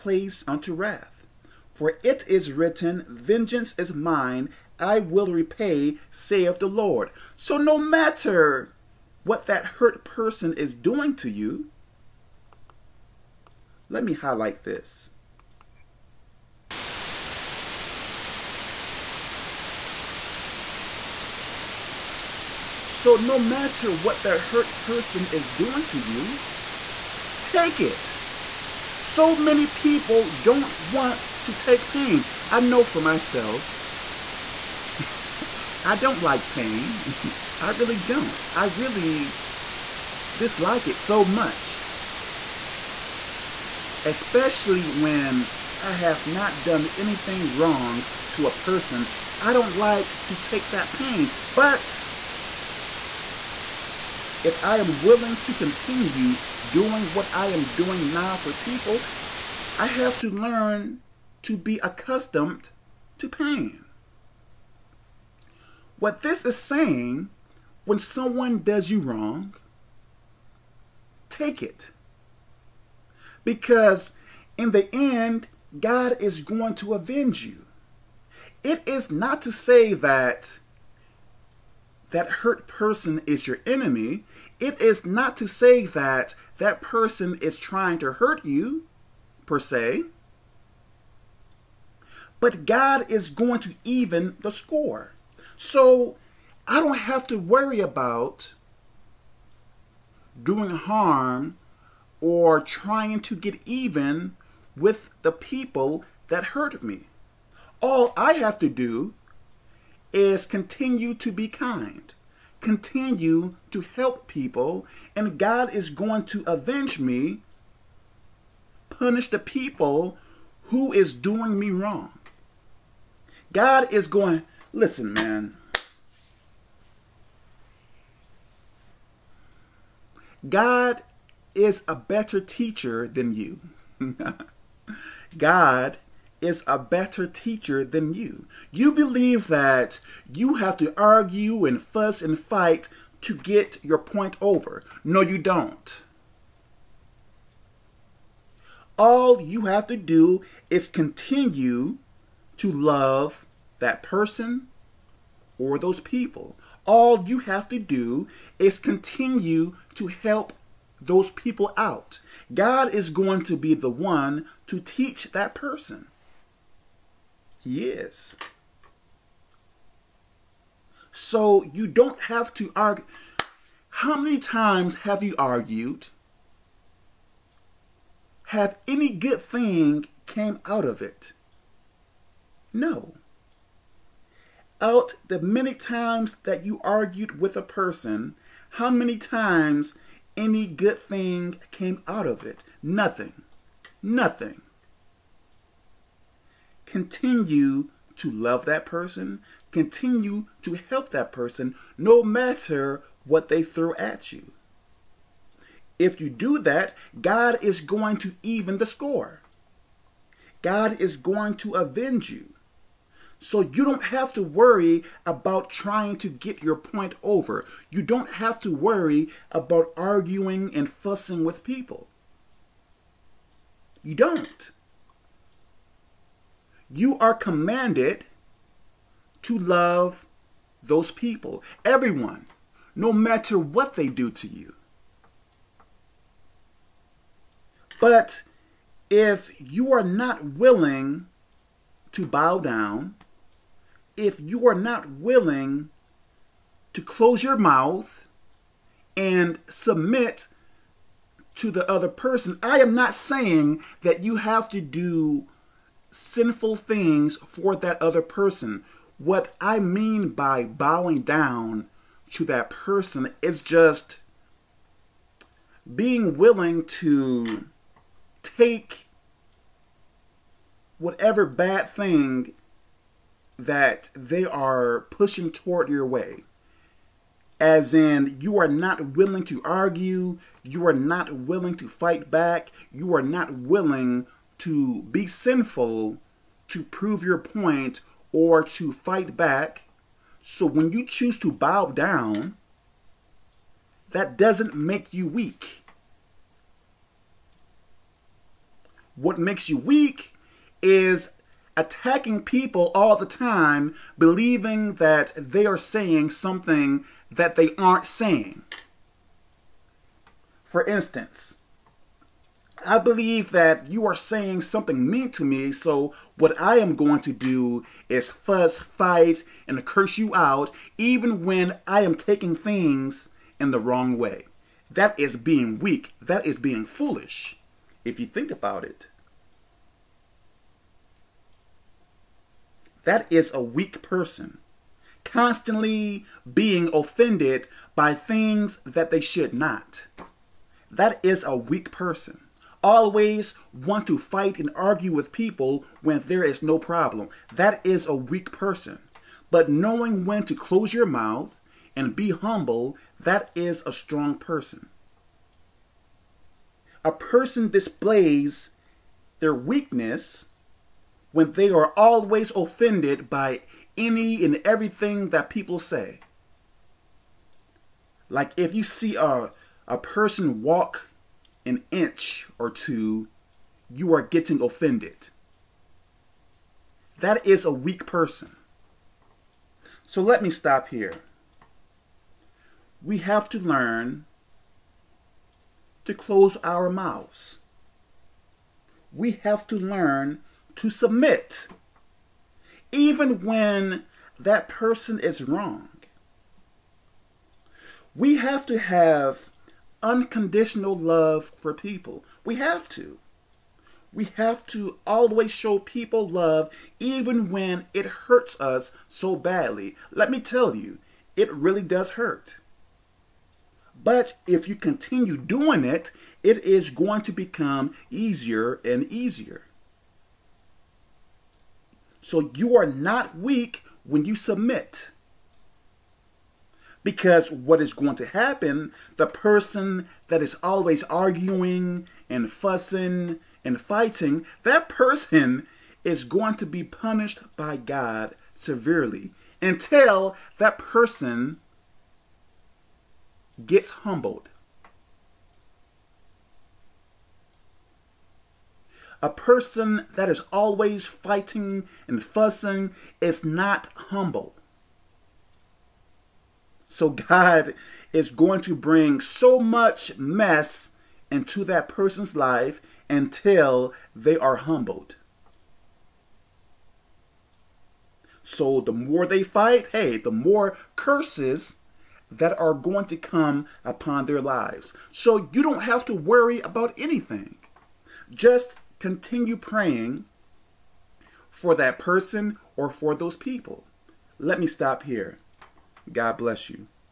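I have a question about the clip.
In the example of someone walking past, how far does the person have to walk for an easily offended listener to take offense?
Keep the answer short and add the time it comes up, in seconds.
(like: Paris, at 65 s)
An inch or two, at 371 s.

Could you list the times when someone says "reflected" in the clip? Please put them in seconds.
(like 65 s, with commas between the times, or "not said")
not said.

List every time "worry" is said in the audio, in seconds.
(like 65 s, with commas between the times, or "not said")
97 s, 214 s, 218 s, 476 s.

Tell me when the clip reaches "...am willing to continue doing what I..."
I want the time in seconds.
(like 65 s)
54 s.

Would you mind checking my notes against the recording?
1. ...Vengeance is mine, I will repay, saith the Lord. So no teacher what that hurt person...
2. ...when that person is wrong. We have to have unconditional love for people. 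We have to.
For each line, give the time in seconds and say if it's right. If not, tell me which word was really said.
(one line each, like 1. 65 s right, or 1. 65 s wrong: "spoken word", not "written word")
1. 3 s wrong: "matter", not "teacher"
2. 393 s right.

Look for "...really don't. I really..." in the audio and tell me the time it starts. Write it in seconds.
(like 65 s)
37 s.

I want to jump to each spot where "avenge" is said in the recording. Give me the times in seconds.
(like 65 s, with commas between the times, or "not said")
76 s, 116 s, 211 s.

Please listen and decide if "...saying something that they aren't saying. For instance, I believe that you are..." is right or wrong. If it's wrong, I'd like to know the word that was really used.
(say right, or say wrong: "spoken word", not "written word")
right.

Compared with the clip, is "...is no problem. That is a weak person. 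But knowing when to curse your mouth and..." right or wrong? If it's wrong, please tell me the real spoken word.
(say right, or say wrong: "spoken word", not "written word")
wrong: "close", not "curse".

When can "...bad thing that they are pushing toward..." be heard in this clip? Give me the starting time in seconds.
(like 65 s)
271 s.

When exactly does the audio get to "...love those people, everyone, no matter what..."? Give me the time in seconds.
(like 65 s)
229 s.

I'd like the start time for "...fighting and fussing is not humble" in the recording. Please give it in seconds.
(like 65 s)
451 s.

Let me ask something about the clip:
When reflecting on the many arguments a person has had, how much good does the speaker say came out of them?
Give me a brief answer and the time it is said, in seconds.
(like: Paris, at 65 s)
Nothing, at 192 s.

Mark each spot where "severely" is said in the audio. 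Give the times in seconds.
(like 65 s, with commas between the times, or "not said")
438 s.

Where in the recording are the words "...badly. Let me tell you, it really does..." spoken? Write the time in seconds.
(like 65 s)
409 s.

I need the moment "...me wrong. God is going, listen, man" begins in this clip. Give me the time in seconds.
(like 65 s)
121 s.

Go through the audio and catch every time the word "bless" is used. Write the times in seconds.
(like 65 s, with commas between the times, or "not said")
486 s.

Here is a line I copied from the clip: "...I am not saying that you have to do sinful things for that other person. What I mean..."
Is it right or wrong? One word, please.
right.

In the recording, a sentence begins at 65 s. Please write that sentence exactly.
What this is saying when someone does you wrong, take it.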